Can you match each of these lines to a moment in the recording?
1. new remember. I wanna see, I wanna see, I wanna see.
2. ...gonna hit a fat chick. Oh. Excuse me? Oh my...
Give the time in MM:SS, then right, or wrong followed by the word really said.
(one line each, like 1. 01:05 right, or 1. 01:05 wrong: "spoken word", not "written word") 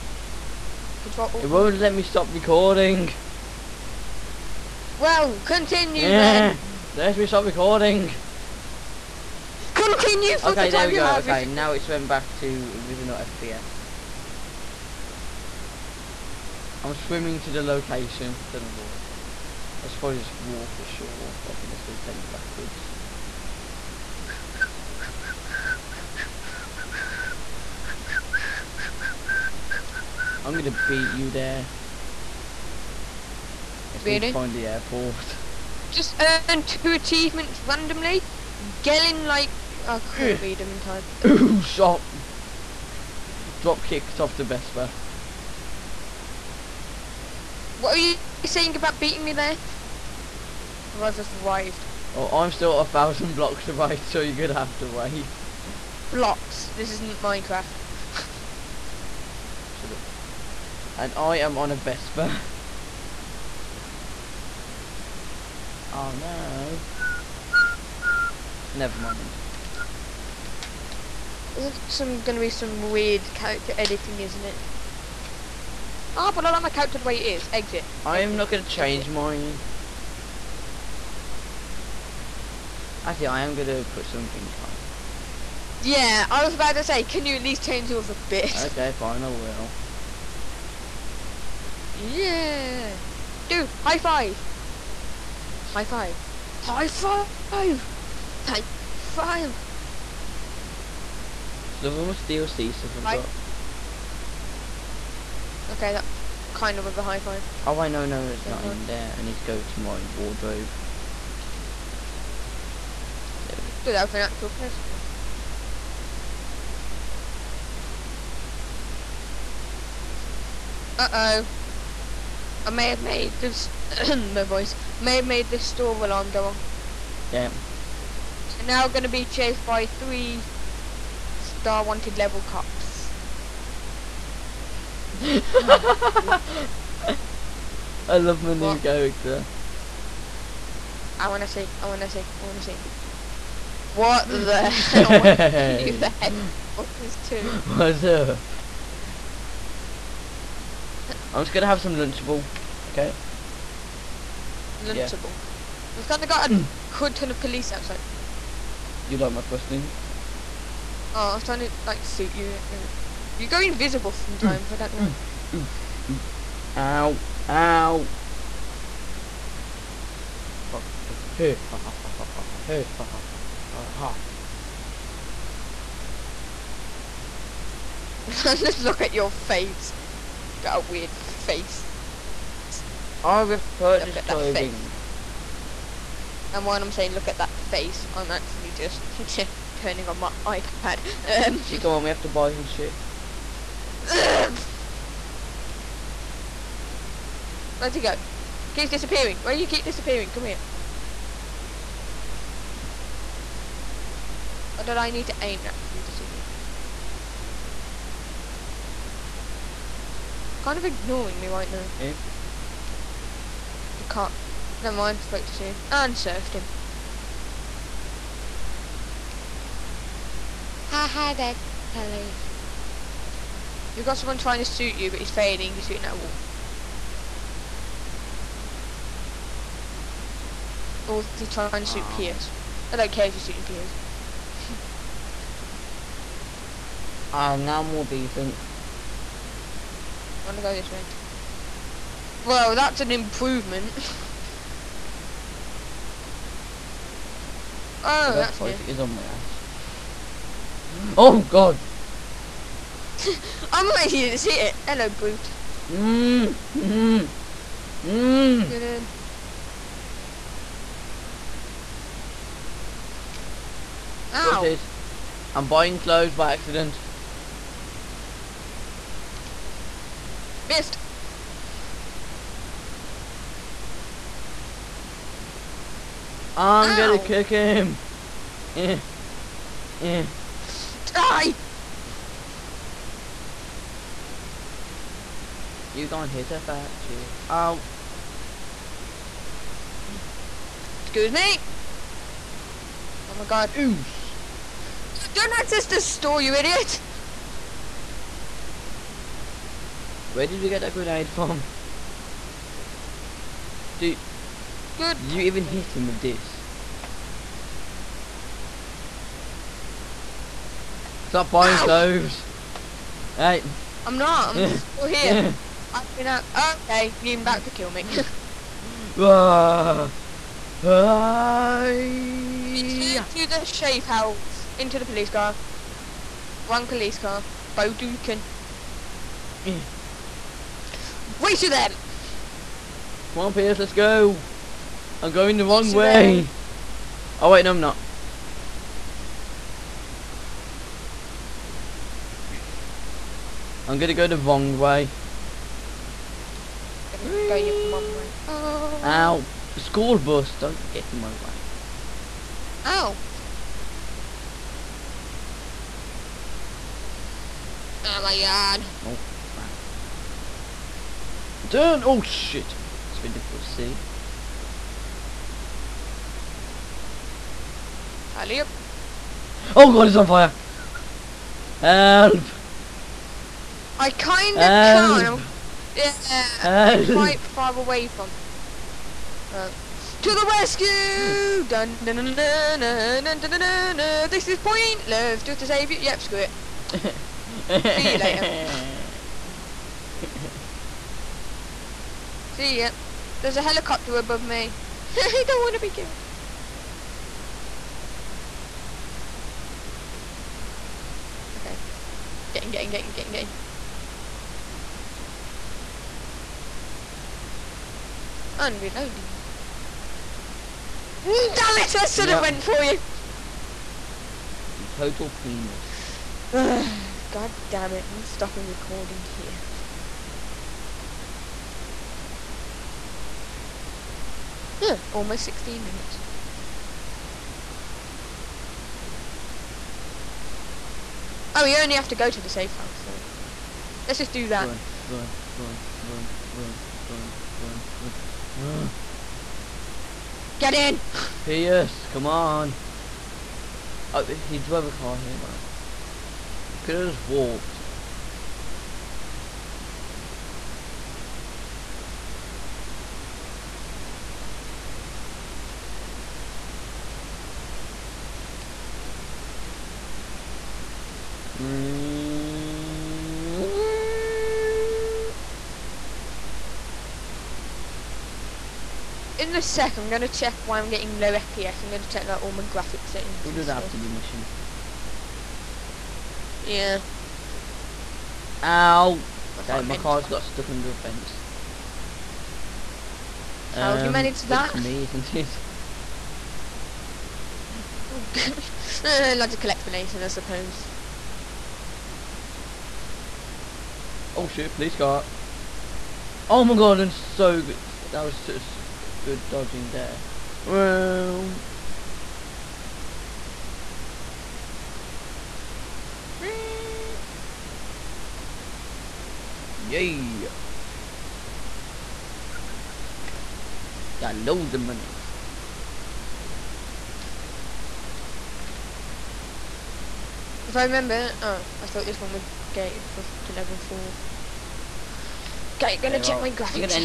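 1. 02:18 wrong: "character", not "remember"
2. 04:46 right.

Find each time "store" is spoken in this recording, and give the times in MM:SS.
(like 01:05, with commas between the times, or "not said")
02:05, 04:55.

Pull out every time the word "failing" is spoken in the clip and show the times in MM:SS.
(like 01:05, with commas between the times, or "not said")
03:45.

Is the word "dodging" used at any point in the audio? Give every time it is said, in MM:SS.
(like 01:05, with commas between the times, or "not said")
08:19.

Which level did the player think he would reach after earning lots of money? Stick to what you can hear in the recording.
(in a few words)
level 4.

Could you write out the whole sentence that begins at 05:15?
I mean, uh, okay, you're about to kill me.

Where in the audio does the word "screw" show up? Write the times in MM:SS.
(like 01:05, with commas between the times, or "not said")
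06:26.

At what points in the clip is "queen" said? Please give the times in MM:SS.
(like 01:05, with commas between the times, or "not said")
not said.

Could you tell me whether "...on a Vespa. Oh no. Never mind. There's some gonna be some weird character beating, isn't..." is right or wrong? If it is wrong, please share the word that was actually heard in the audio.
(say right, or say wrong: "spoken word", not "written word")
wrong: "editing", not "beating".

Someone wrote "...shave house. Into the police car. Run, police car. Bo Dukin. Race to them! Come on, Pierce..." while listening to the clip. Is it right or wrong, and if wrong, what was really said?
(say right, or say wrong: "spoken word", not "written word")
right.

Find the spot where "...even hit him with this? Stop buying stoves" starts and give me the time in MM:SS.
05:05.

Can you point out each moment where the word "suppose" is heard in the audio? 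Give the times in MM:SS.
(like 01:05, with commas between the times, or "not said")
00:19, 08:10.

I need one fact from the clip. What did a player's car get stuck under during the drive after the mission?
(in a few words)
a fence.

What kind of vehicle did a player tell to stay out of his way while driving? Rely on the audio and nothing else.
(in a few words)
School bus.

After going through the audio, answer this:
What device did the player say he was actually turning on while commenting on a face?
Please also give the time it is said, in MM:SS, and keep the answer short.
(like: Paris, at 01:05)
iPad, at 03:10.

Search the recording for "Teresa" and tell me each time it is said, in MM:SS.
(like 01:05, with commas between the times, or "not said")
not said.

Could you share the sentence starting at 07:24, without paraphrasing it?
Oh, he drove a car here, well.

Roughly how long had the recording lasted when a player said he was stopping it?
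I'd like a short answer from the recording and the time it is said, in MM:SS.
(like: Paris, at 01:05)
almost 16 minutes, at 07:05.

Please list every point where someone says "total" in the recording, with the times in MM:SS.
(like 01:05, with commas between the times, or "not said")
06:54.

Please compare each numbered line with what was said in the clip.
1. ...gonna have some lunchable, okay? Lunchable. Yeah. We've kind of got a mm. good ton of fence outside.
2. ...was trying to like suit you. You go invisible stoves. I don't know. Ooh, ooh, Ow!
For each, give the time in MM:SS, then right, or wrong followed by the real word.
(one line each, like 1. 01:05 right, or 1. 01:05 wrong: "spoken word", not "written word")
1. 02:31 wrong: "police", not "fence"
2. 02:41 wrong: "sometimes", not "stoves".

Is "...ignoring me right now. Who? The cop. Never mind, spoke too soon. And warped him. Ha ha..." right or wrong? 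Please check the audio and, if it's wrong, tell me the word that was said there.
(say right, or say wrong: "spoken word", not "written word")
wrong: "surfed", not "warped".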